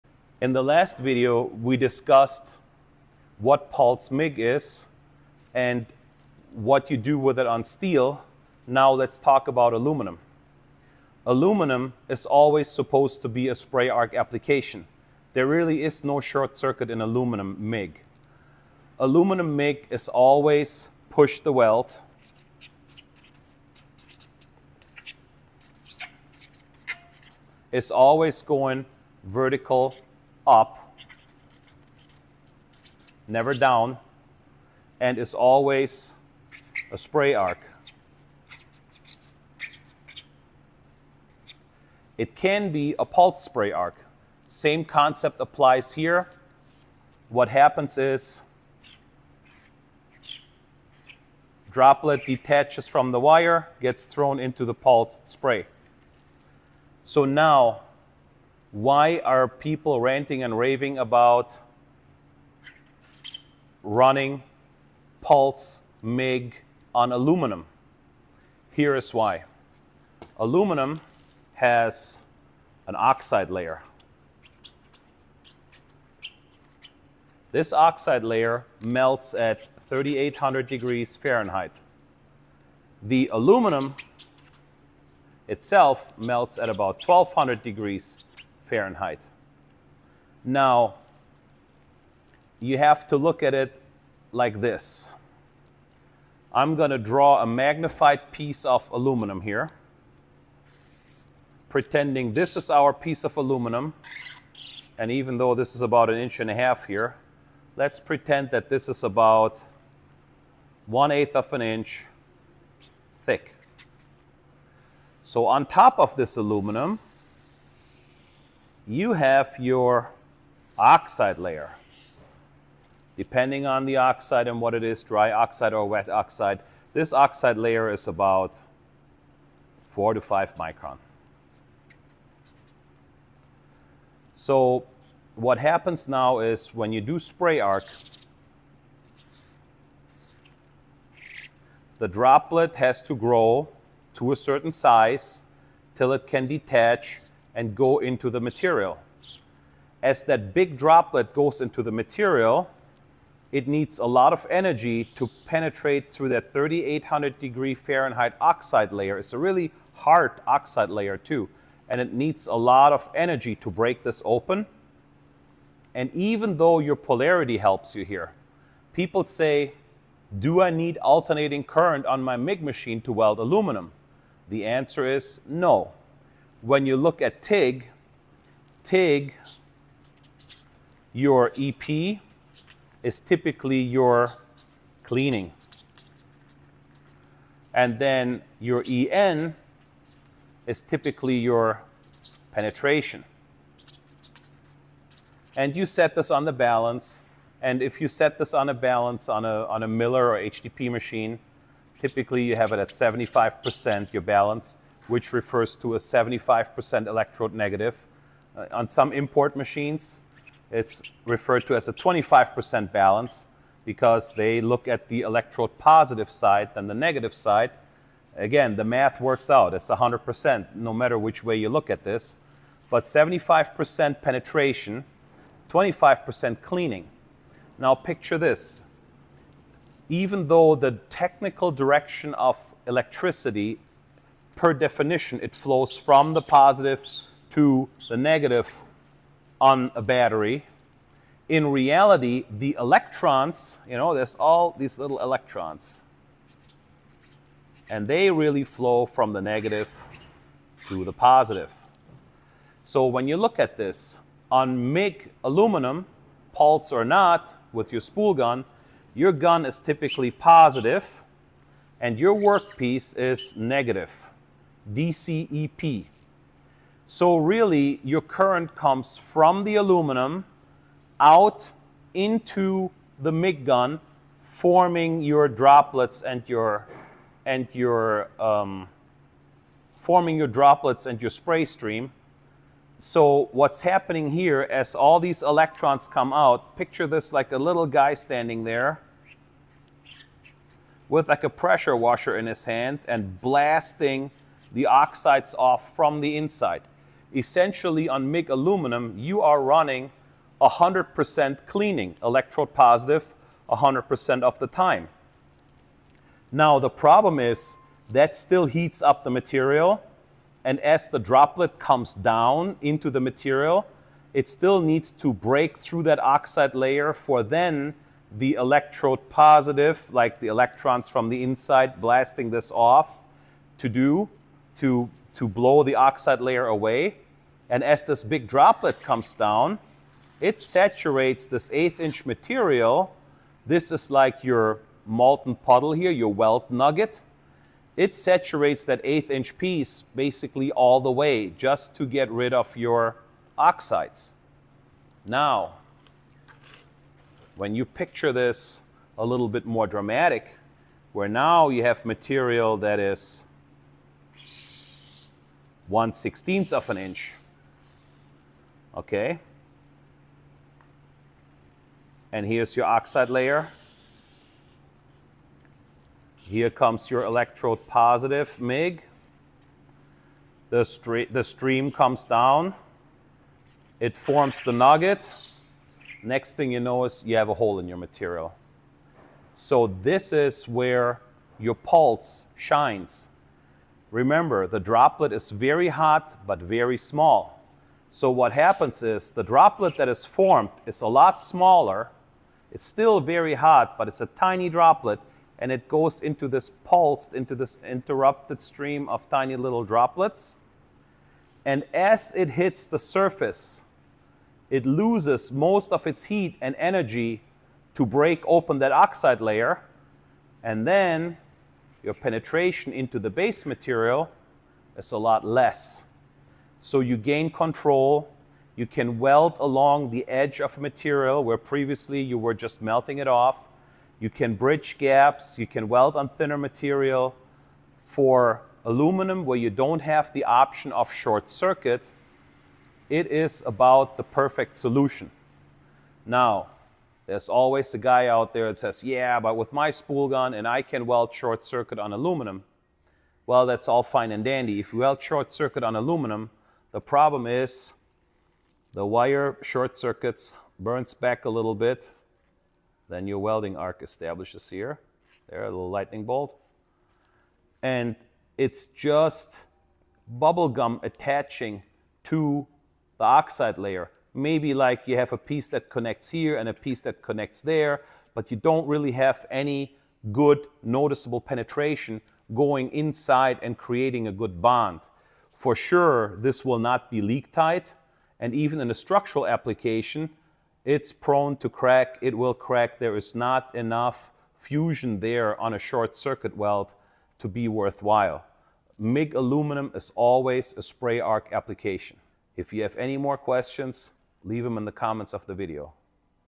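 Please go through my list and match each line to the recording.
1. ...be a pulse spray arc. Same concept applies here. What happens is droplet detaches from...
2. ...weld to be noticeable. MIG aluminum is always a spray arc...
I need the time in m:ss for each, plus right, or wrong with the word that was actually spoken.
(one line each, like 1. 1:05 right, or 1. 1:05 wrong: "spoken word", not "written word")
1. 0:42 right
2. 8:06 wrong: "worthwhile", not "noticeable".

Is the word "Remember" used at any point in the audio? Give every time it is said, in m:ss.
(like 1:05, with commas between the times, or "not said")
6:24.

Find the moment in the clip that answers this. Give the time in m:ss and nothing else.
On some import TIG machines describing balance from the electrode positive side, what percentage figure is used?
3:31.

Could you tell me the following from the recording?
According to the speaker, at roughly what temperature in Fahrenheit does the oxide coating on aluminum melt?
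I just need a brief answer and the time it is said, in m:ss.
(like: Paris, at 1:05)
3800 degrees Fahrenheit, at 1:19.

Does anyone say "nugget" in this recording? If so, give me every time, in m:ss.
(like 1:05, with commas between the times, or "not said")
5:36, 6:14.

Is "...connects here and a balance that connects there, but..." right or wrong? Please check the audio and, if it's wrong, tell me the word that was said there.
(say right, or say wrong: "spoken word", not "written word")
wrong: "piece", not "balance".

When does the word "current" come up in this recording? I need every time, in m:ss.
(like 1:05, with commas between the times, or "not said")
2:51, 4:28.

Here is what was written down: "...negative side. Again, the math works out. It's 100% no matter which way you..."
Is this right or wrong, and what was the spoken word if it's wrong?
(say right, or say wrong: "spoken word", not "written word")
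right.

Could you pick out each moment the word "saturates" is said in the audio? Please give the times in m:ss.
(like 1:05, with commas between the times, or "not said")
5:30, 5:38.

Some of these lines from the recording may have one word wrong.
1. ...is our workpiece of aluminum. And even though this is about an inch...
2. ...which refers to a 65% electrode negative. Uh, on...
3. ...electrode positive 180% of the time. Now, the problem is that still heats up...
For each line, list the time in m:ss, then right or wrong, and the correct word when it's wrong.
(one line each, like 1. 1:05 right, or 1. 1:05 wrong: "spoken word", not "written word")
1. 1:42 wrong: "piece", not "workpiece"
2. 3:25 wrong: "75", not "65"
3. 5:02 wrong: "100", not "180".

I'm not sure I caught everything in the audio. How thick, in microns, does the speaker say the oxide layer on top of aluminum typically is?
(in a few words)
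4 to 5 micron.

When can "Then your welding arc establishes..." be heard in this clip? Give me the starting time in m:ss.
7:33.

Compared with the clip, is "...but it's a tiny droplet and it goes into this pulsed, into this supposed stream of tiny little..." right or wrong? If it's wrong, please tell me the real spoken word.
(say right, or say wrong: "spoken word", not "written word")
wrong: "interrupted", not "supposed".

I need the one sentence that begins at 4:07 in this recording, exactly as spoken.
And they really flow from the negative to the positive.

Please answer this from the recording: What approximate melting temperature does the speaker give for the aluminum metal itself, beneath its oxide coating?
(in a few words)
1200 degrees Fahrenheit.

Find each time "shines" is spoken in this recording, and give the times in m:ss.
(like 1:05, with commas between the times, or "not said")
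6:22.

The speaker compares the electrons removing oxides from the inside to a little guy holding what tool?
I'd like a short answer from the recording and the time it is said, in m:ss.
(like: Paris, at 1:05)
Pressure washer, at 4:51.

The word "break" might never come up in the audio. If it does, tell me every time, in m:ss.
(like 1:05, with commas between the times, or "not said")
2:43, 5:15, 6:48.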